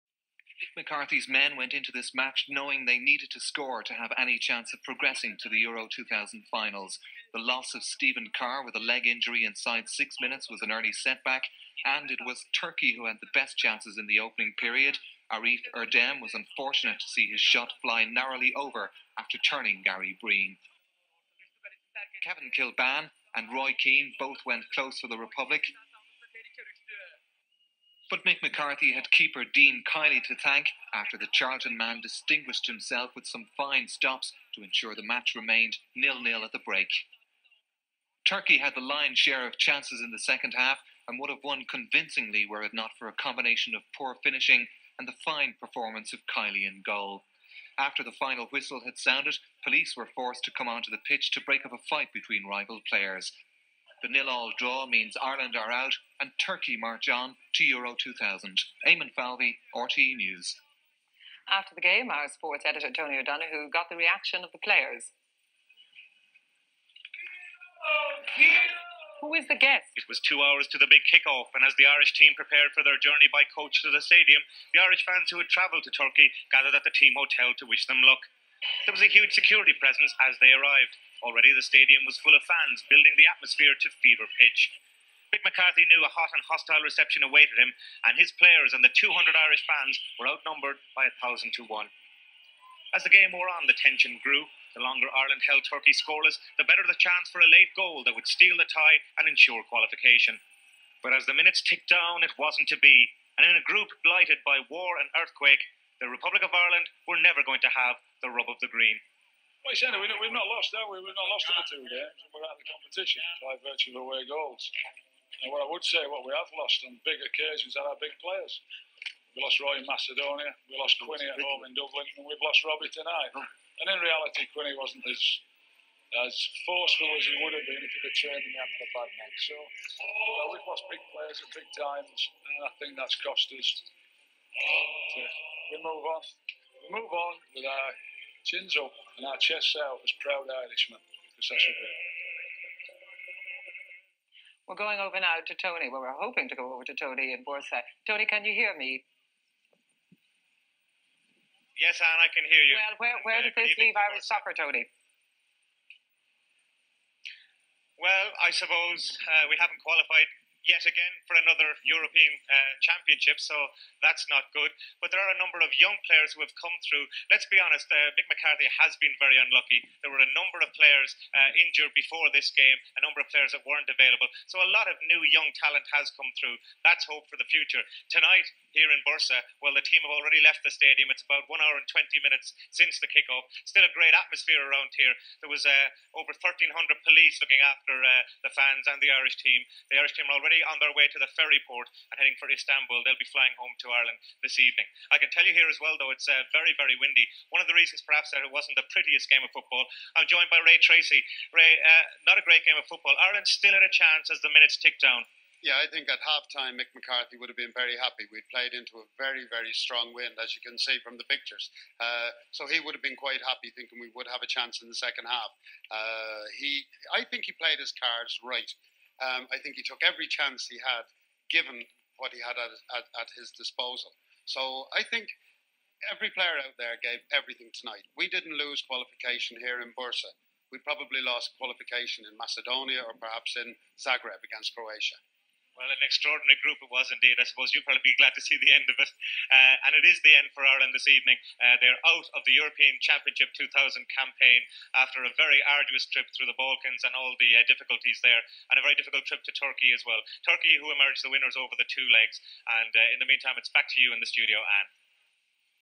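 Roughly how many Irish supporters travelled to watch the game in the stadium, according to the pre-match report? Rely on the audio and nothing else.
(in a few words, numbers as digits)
200.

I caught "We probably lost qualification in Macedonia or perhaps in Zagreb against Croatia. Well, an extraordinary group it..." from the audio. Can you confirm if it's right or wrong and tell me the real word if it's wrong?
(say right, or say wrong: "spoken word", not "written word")
right.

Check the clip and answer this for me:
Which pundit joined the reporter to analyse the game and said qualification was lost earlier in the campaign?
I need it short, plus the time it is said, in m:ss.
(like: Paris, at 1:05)
Ray Treacy, at 3:20.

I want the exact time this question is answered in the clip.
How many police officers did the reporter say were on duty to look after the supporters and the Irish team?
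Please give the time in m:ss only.
3:06.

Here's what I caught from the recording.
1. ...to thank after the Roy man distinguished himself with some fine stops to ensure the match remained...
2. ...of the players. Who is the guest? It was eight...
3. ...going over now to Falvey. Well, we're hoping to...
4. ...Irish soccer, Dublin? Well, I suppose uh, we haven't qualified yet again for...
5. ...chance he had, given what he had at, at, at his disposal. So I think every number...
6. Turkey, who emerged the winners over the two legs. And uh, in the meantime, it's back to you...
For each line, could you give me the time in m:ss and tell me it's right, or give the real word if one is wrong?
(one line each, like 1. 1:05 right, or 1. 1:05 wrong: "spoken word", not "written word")
1. 0:30 wrong: "Charlton", not "Roy"
2. 1:04 wrong: "two", not "eight"
3. 2:24 wrong: "Tony", not "Falvey"
4. 2:33 wrong: "Tony", not "Dublin"
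5. 3:40 wrong: "player", not "number"
6. 4:10 right.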